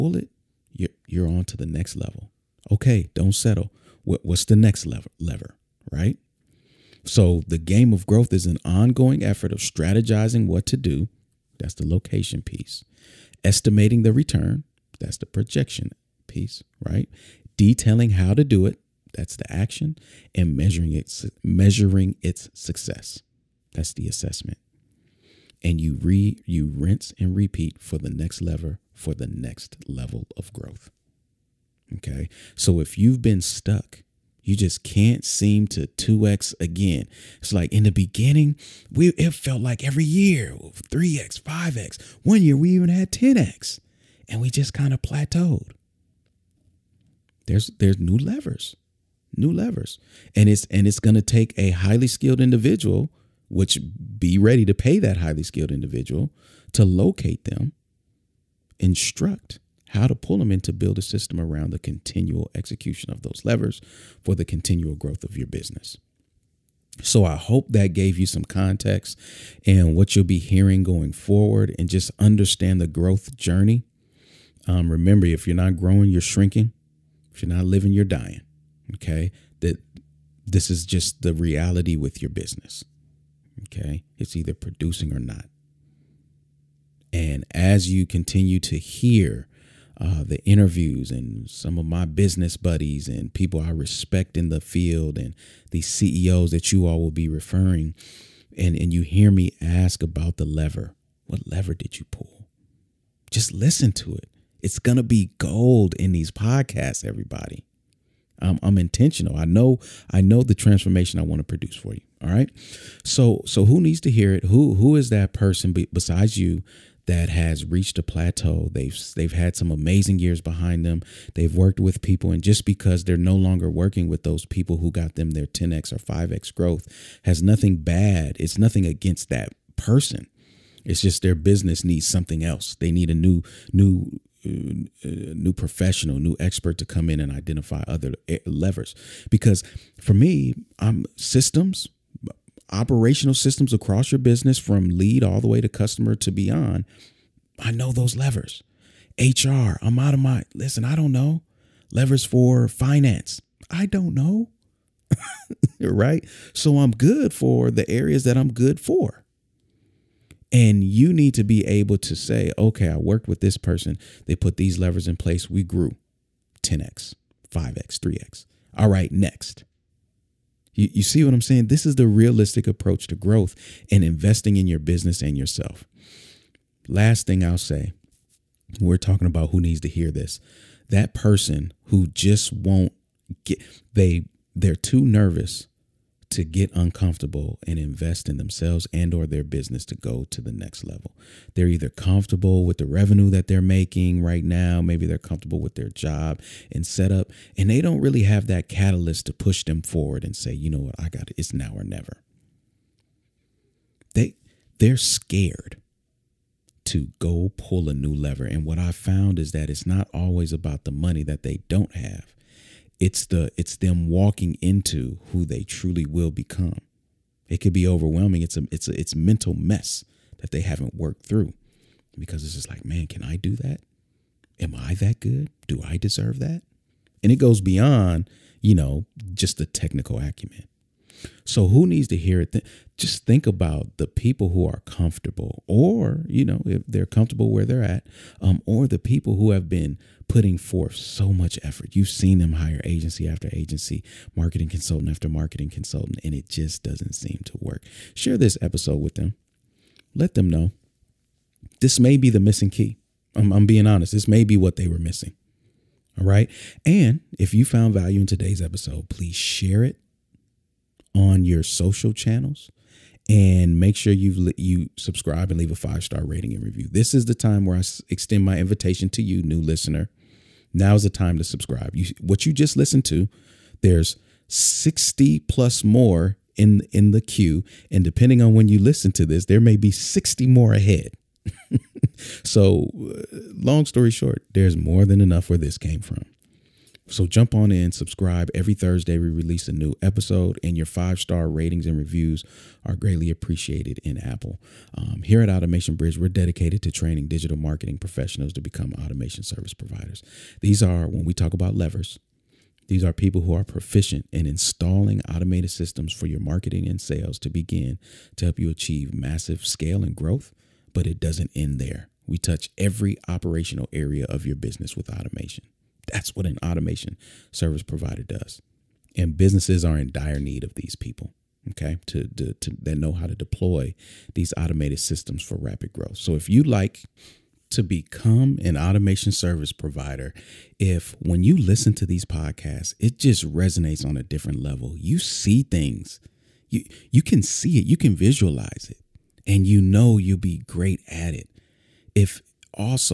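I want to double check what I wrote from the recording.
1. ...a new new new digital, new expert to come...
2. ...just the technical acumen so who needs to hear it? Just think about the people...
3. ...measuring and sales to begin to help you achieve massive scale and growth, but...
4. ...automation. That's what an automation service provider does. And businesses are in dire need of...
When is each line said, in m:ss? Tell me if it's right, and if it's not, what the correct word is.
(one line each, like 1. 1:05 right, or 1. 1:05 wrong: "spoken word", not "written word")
1. 2:13 wrong: "professional", not "digital"
2. 3:49 right
3. 5:06 wrong: "marketing", not "measuring"
4. 5:15 right.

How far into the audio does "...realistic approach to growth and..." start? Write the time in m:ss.
2:52.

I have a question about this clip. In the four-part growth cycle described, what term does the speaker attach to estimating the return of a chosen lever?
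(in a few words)
Projection.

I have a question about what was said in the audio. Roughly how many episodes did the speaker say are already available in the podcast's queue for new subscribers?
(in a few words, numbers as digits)
60 plus.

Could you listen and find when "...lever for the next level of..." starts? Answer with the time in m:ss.
0:28.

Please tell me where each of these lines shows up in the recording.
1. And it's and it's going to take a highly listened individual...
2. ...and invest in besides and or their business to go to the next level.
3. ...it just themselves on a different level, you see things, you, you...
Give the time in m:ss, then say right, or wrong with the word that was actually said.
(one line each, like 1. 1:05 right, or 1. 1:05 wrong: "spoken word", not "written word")
1. 0:50 wrong: "skilled", not "listened"
2. 3:07 wrong: "themselves", not "besides"
3. 5:32 wrong: "resonates", not "themselves".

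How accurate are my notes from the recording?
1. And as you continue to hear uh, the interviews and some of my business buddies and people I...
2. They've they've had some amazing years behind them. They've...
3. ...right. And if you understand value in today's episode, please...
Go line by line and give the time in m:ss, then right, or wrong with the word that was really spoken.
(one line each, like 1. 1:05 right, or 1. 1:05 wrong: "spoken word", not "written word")
1. 1:27 right
2. 1:58 right
3. 4:16 wrong: "found", not "understand".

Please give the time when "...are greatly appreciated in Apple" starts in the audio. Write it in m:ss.
4:52.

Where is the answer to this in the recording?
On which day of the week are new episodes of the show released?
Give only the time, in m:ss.
4:48.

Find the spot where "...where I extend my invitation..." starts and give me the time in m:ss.
4:27.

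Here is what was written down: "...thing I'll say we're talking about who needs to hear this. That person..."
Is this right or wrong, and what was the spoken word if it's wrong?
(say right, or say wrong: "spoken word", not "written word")
right.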